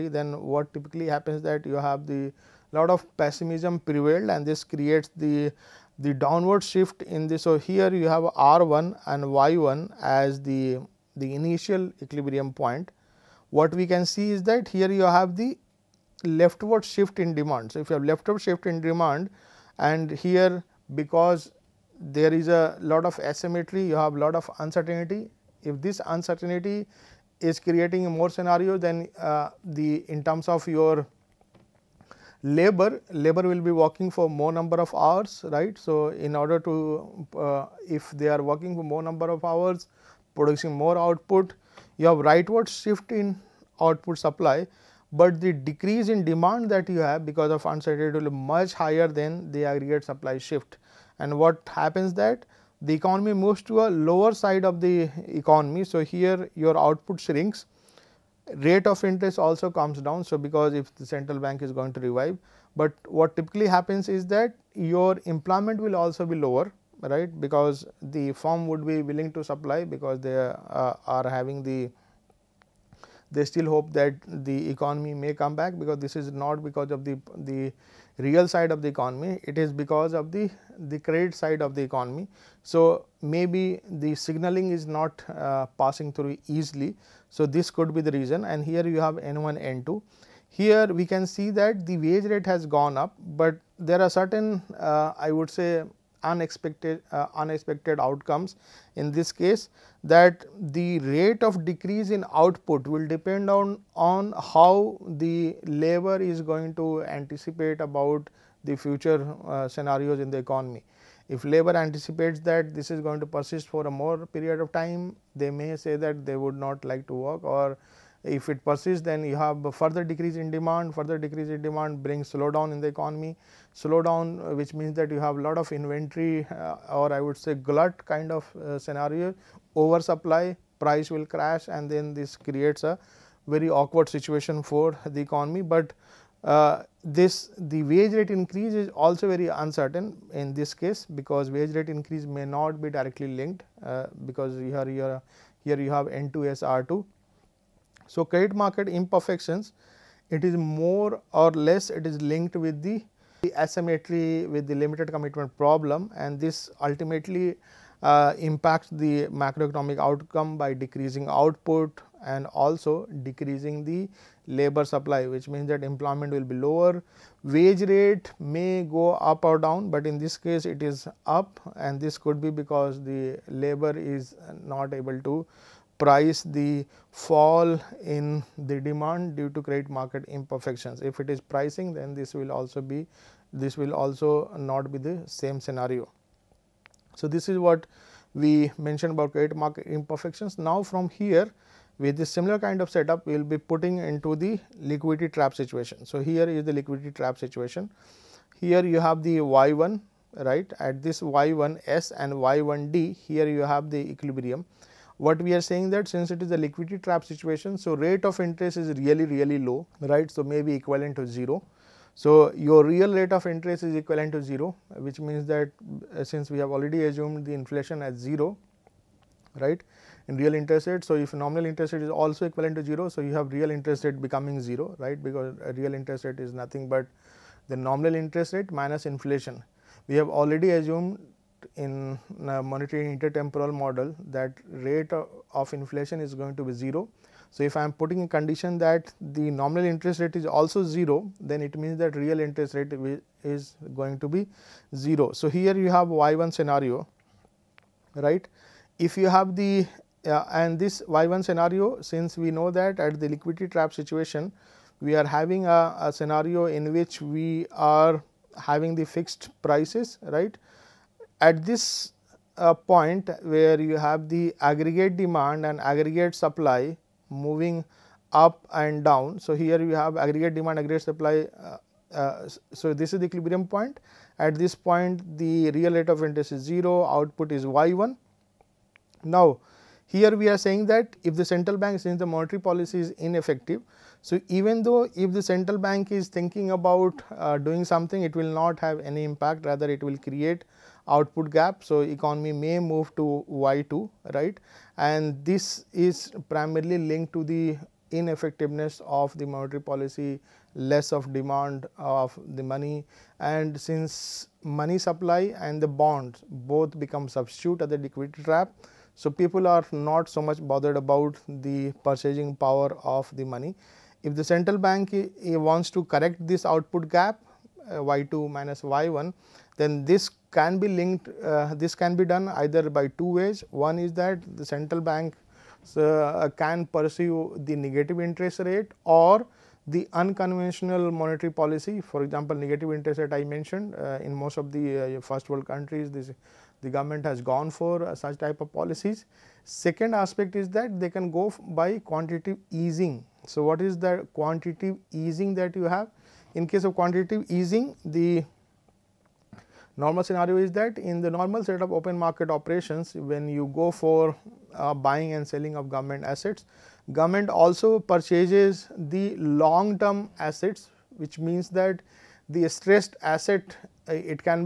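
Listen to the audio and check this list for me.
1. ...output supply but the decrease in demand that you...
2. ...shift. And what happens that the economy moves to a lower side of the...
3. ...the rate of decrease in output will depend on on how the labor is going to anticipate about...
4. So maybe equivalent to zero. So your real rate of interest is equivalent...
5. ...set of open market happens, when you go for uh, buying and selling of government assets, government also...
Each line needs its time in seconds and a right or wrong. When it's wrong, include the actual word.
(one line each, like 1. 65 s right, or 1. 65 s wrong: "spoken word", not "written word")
1. 43 s right
2. 50 s right
3. 100 s right
4. 210 s right
5. 351 s wrong: "operations", not "happens".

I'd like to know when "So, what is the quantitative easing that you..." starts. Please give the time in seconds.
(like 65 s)
343 s.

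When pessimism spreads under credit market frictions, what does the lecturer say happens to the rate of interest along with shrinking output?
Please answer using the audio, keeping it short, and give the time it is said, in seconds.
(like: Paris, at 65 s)
comes down, at 58 s.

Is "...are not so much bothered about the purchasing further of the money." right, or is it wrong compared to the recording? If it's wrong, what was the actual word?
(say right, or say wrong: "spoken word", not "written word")
wrong: "power", not "further".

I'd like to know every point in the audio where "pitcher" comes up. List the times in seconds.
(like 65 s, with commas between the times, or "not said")
not said.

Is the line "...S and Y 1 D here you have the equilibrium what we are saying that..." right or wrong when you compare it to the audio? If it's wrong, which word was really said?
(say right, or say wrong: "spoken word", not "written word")
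right.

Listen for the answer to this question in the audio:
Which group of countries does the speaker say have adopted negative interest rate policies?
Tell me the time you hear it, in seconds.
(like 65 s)
335 s.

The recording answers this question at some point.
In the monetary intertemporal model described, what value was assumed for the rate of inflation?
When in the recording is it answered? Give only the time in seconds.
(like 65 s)
234 s.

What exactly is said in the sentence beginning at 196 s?
So, here is the liquidity trap situation.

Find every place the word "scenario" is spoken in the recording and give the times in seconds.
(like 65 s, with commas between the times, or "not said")
28 s, 109 s, 128 s, 185 s, 246 s, 251 s, 256 s, 350 s.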